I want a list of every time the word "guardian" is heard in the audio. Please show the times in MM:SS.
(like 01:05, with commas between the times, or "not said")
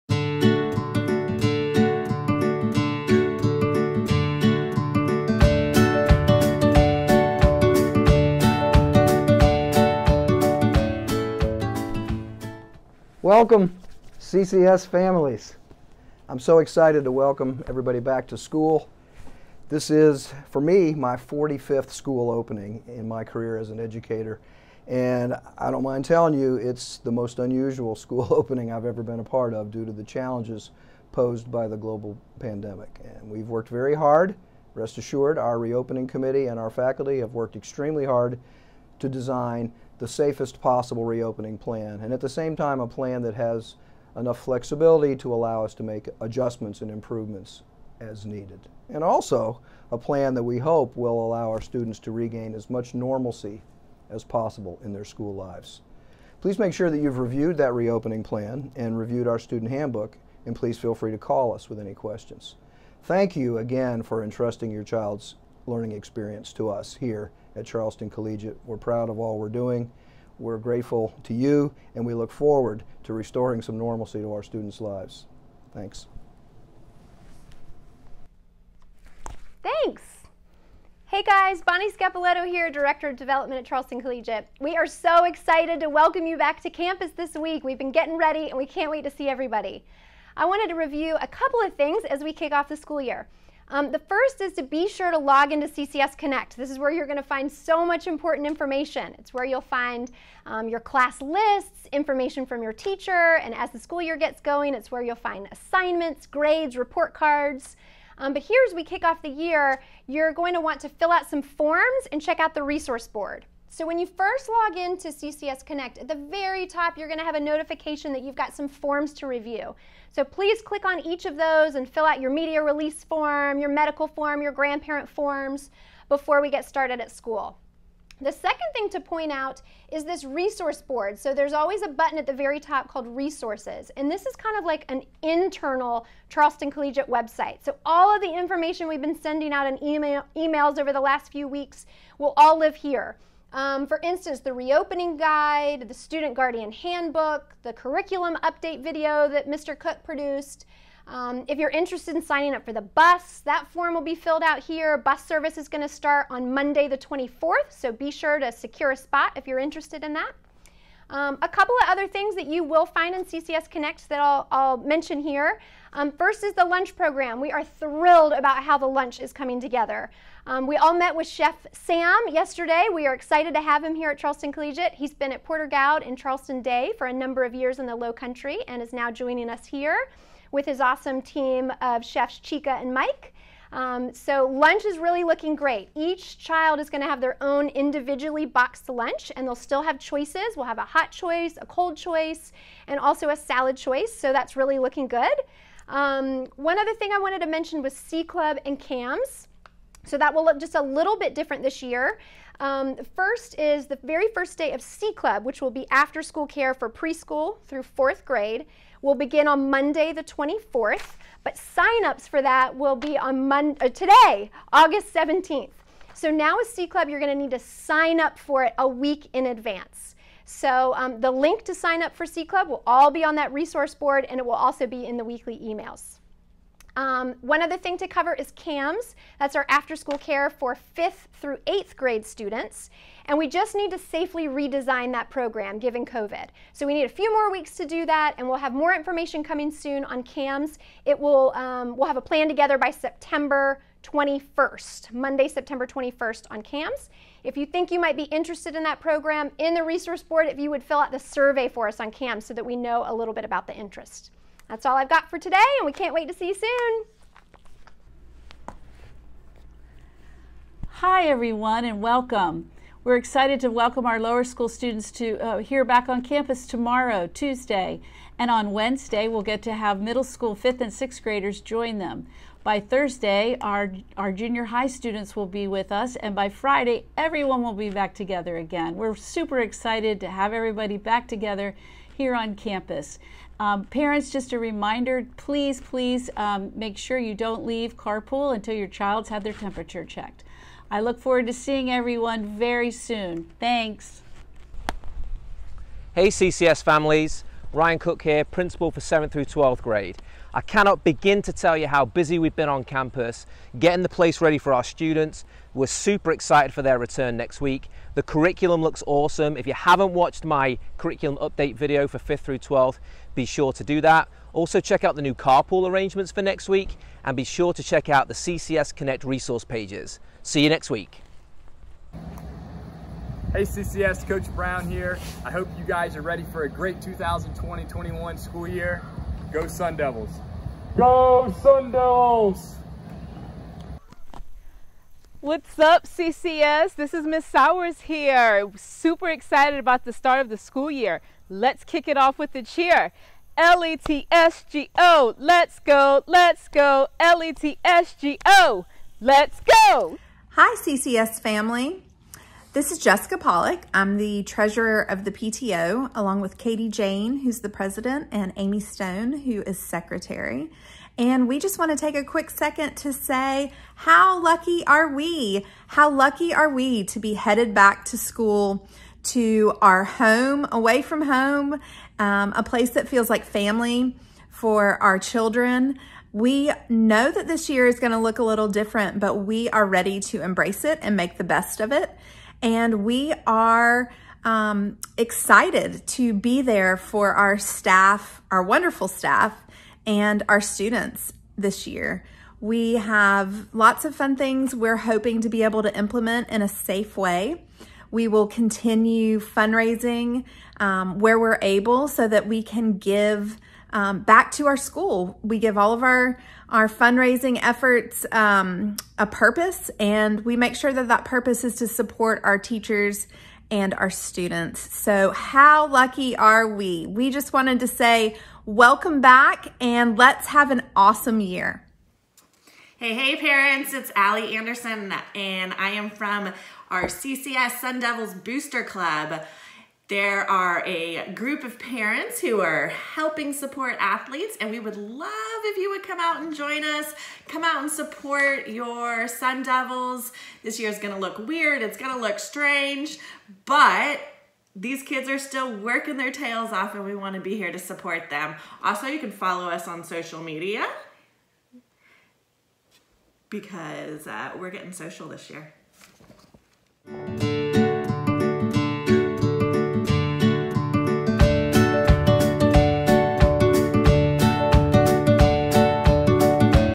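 02:26.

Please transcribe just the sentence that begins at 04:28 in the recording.
And on Wednesday, we'll get to have middle school fifth and sixth graders join them.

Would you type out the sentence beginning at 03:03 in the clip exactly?
Um, so lunch is really looking great.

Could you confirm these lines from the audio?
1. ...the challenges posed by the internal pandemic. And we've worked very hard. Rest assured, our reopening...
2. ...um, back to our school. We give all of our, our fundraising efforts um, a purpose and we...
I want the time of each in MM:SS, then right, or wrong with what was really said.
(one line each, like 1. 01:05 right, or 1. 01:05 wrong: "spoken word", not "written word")
1. 00:29 wrong: "global", not "internal"
2. 06:43 right.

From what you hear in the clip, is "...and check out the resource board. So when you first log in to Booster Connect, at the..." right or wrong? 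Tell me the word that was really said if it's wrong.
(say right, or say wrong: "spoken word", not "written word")
wrong: "CCS", not "Booster".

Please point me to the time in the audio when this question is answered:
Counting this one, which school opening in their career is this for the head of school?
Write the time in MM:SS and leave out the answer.
00:21.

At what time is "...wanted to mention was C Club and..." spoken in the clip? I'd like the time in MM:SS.
03:17.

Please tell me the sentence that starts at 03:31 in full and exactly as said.
But signups for that will be on Monday, uh, today, August 17th.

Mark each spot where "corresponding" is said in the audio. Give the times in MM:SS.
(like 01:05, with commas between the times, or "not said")
not said.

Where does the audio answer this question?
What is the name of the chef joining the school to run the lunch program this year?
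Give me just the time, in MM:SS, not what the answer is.
02:51.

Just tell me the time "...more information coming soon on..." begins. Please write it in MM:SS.
03:58.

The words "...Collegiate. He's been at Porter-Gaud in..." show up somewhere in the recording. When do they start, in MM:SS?
02:54.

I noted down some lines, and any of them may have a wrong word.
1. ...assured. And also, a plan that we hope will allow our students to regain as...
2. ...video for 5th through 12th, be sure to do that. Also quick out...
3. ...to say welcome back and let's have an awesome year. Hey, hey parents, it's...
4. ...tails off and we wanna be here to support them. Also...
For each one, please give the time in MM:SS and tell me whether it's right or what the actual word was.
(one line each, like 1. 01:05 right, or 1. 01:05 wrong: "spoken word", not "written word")
1. 00:48 wrong: "needed", not "assured"
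2. 05:11 wrong: "check", not "quick"
3. 06:57 right
4. 07:26 right.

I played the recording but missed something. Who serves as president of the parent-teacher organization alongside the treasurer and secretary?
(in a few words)
Katie Jane.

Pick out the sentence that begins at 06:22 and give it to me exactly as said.
And we are um, excited to be there for our staff, our wonderful staff, and our students this year.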